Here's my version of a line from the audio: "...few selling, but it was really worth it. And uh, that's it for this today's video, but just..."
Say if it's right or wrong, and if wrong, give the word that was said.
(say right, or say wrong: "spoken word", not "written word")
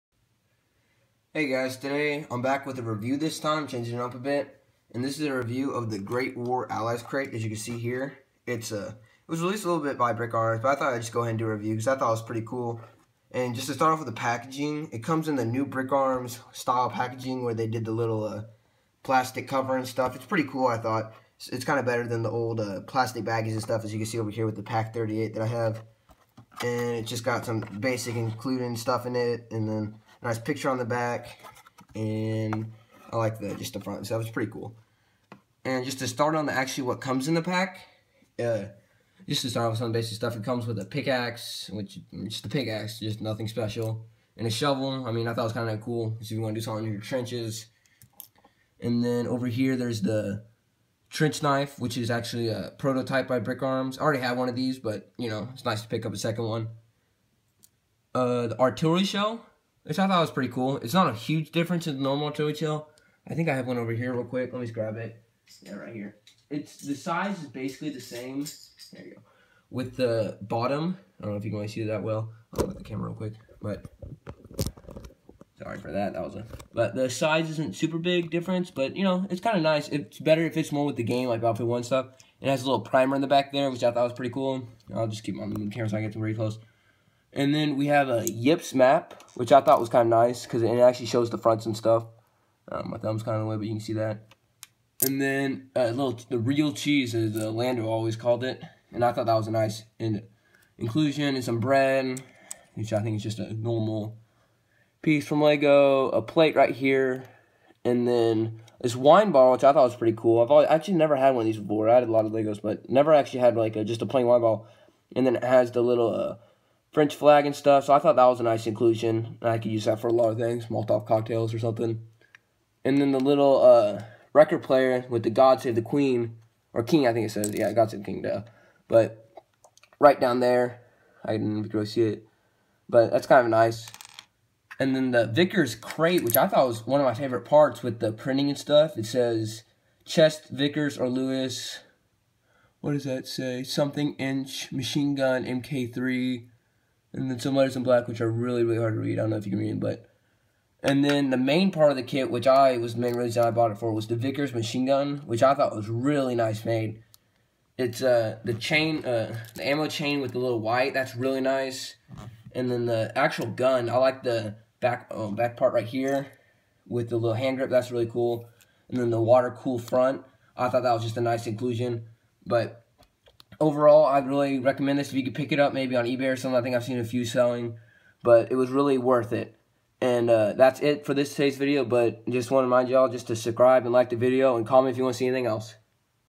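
right.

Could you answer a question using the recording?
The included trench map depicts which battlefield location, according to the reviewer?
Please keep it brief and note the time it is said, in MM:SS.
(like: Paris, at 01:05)
Ypres, at 01:28.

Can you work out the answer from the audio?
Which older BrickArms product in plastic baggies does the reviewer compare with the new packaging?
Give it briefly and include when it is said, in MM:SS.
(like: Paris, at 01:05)
Pack 38, at 00:24.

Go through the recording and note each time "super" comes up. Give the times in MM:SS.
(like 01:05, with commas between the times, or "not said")
01:17.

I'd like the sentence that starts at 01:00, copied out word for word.
It's not a huge difference in the normal Joey Chill.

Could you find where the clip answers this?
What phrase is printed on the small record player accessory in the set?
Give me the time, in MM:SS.
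02:07.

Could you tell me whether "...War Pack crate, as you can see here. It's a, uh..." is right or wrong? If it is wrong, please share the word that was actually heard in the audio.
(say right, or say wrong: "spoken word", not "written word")
wrong: "Allies", not "Pack".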